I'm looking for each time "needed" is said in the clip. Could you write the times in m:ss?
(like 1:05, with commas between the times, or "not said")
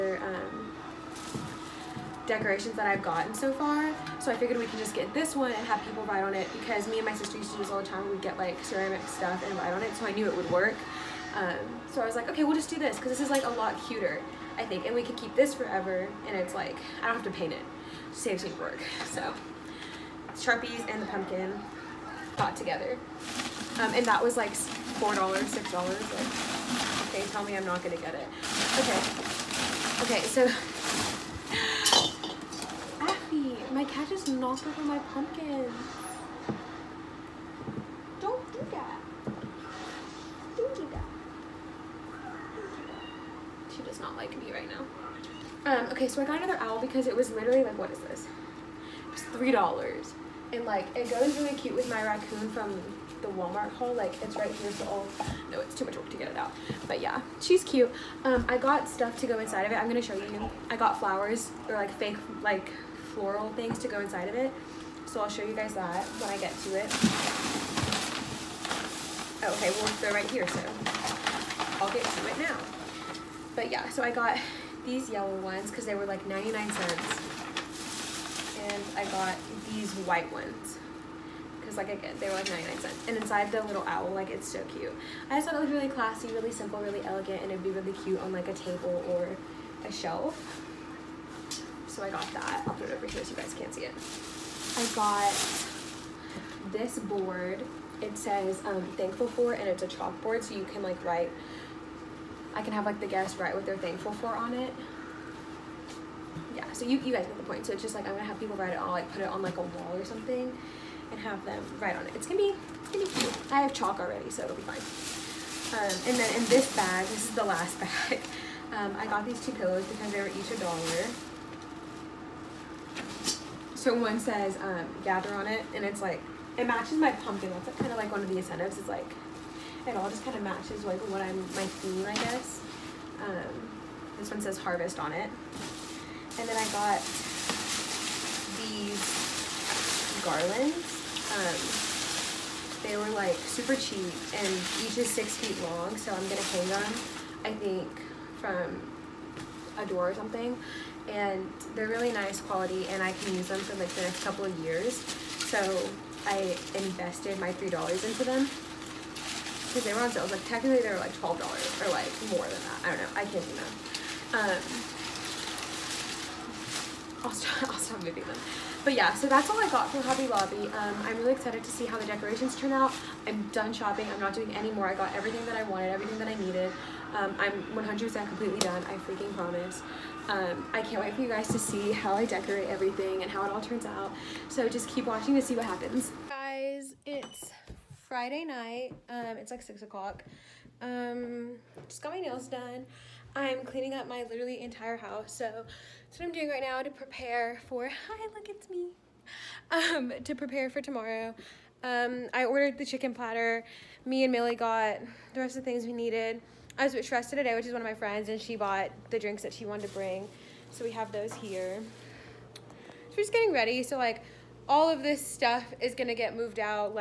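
2:56, 3:25.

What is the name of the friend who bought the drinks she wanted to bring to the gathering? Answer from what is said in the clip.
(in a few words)
Shrestha.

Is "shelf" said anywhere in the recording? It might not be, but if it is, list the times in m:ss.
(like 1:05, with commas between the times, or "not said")
1:29.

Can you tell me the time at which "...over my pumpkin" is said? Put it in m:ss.
0:34.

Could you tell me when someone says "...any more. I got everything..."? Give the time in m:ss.
2:54.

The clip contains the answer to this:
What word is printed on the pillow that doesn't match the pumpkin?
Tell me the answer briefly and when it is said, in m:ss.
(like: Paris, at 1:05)
harvest, at 2:14.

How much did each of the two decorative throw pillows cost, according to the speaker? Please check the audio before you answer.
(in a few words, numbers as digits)
$1.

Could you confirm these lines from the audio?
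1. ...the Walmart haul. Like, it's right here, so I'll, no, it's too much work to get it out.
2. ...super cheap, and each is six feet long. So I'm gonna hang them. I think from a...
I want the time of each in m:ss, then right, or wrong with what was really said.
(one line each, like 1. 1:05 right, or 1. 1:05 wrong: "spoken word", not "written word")
1. 0:53 right
2. 2:23 right.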